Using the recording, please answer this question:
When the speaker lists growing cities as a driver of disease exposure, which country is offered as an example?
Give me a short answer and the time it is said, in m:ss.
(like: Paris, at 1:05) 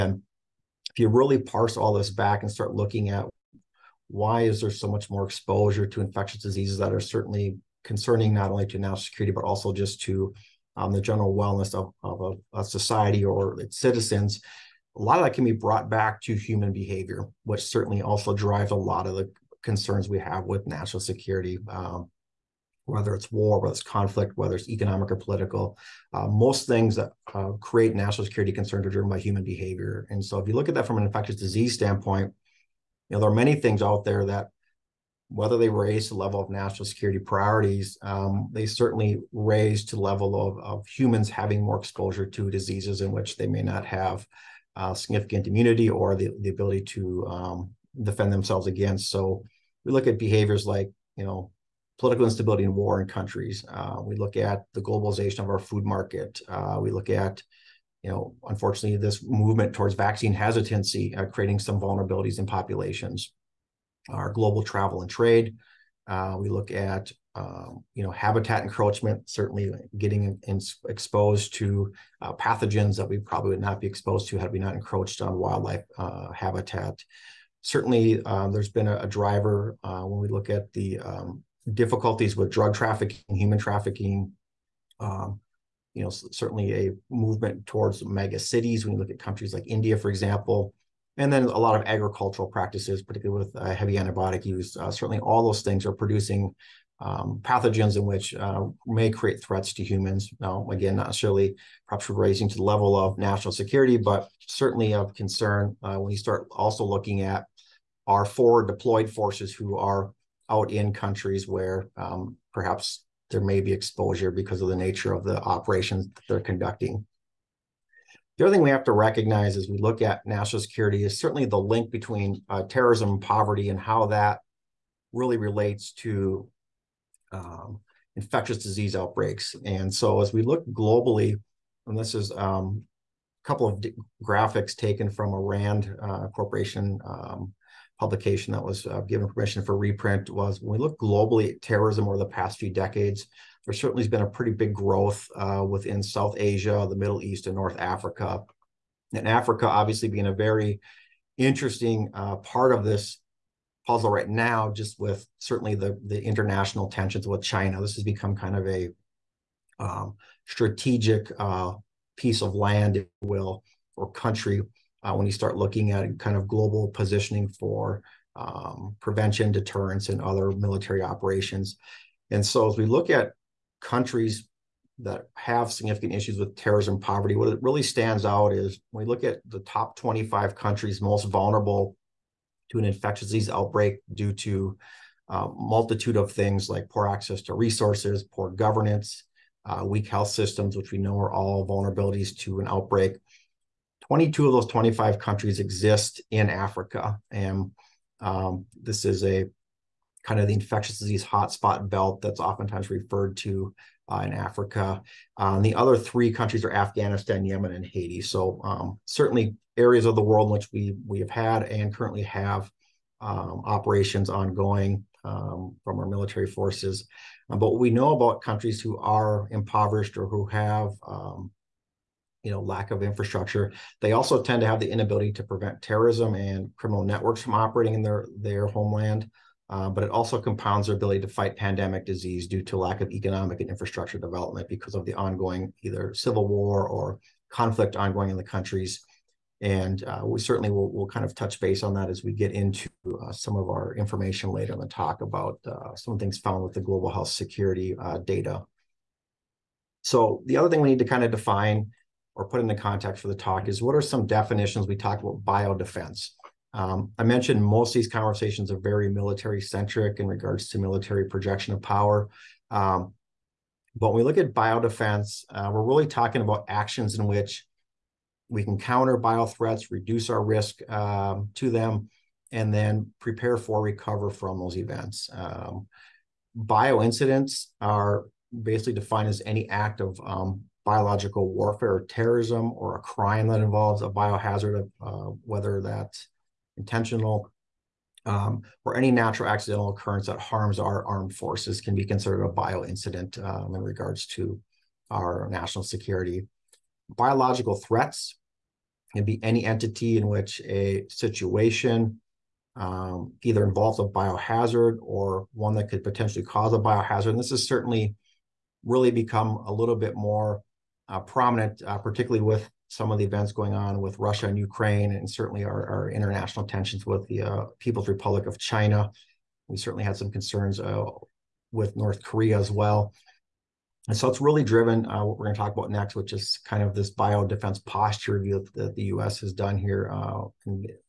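India, at 1:29.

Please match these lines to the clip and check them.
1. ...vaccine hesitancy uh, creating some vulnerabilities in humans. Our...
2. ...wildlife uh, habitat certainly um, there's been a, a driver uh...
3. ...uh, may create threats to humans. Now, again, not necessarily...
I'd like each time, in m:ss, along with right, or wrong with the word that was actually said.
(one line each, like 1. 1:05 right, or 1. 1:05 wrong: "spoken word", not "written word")
1. 0:59 wrong: "populations", not "humans"
2. 1:15 right
3. 1:38 right.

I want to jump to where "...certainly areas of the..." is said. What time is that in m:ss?
3:29.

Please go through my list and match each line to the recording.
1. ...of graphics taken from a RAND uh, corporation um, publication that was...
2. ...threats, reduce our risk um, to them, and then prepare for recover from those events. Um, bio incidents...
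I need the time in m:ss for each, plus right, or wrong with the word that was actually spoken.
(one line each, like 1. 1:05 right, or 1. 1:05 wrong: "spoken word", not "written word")
1. 2:13 right
2. 4:29 right.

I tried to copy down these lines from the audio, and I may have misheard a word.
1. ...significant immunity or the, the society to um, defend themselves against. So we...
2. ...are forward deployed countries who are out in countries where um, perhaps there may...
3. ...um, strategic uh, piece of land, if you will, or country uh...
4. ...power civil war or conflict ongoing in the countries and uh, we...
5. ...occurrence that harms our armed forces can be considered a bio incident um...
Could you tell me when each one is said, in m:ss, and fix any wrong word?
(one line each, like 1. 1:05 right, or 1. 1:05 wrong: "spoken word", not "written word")
1. 0:44 wrong: "ability", not "society"
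2. 1:48 wrong: "forces", not "countries"
3. 2:39 right
4. 3:55 wrong: "either", not "power"
5. 4:49 right.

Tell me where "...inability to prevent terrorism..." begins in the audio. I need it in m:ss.
3:44.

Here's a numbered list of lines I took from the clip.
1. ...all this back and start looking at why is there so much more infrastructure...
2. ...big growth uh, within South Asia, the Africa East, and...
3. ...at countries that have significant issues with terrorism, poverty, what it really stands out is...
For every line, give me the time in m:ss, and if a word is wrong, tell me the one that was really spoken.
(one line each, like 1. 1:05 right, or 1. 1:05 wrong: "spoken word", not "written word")
1. 0:01 wrong: "exposure", not "infrastructure"
2. 2:24 wrong: "Middle", not "Africa"
3. 2:53 right.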